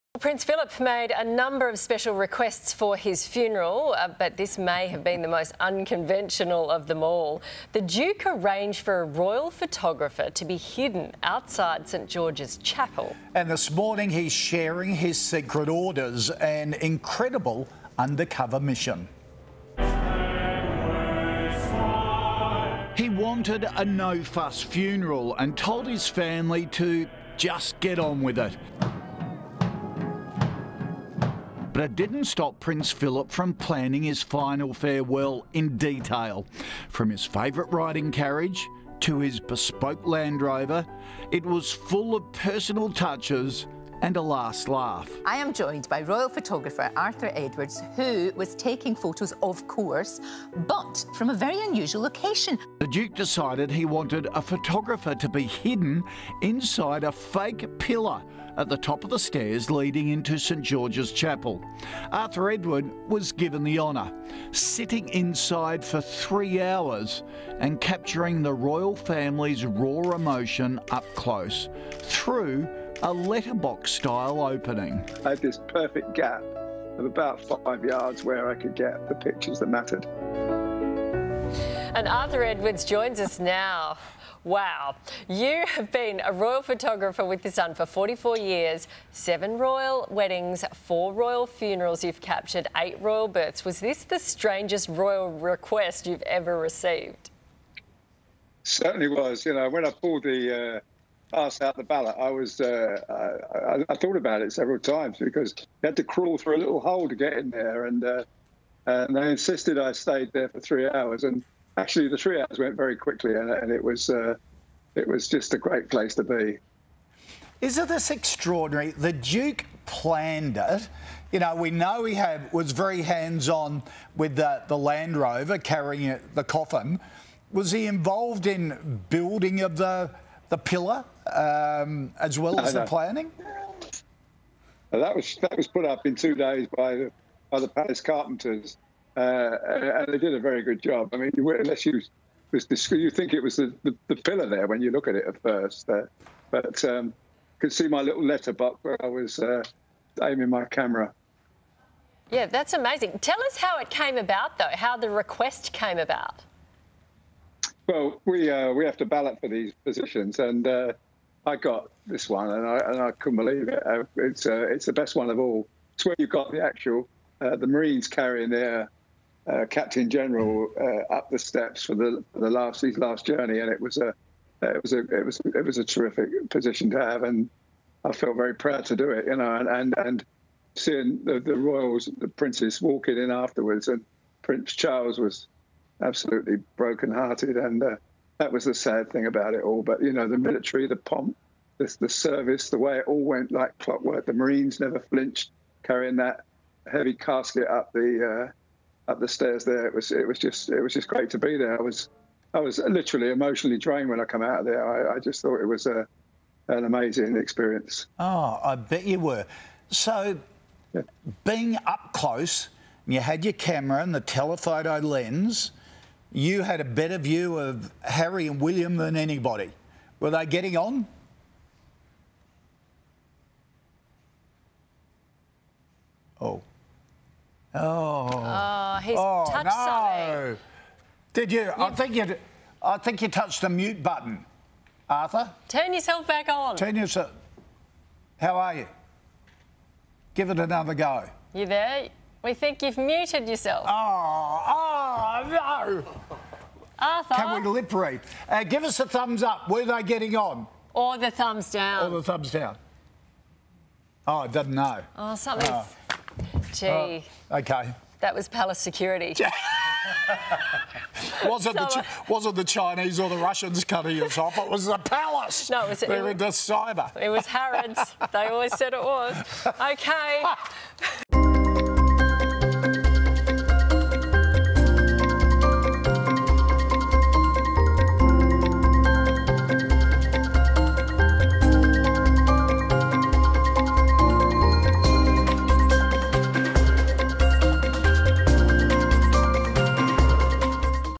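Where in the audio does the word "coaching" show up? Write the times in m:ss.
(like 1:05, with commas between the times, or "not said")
not said.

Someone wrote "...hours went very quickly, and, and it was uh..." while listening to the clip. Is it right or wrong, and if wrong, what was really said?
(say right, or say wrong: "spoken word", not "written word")
right.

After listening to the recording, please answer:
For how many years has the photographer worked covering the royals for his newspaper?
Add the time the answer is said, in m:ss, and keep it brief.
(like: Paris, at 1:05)
44 years, at 1:27.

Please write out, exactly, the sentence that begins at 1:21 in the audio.
And Arthur Edwards joins us now.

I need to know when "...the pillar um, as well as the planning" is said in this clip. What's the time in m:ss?
2:10.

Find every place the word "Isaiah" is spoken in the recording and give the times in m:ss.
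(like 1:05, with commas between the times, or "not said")
not said.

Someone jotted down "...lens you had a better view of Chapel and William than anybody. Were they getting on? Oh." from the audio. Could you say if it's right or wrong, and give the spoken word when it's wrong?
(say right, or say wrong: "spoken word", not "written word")
wrong: "Harry", not "Chapel".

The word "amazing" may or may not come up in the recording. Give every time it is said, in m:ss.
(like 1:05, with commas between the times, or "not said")
2:32, 3:26.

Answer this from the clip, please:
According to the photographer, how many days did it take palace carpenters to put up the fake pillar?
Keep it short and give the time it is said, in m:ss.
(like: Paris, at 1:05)
2 days, at 2:16.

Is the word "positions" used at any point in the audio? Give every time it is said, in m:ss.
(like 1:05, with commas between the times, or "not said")
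2:39, 2:56.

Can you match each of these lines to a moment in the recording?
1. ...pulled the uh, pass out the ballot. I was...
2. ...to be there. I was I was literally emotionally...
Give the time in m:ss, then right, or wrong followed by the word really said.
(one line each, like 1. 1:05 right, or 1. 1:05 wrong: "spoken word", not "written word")
1. 1:39 right
2. 3:21 right.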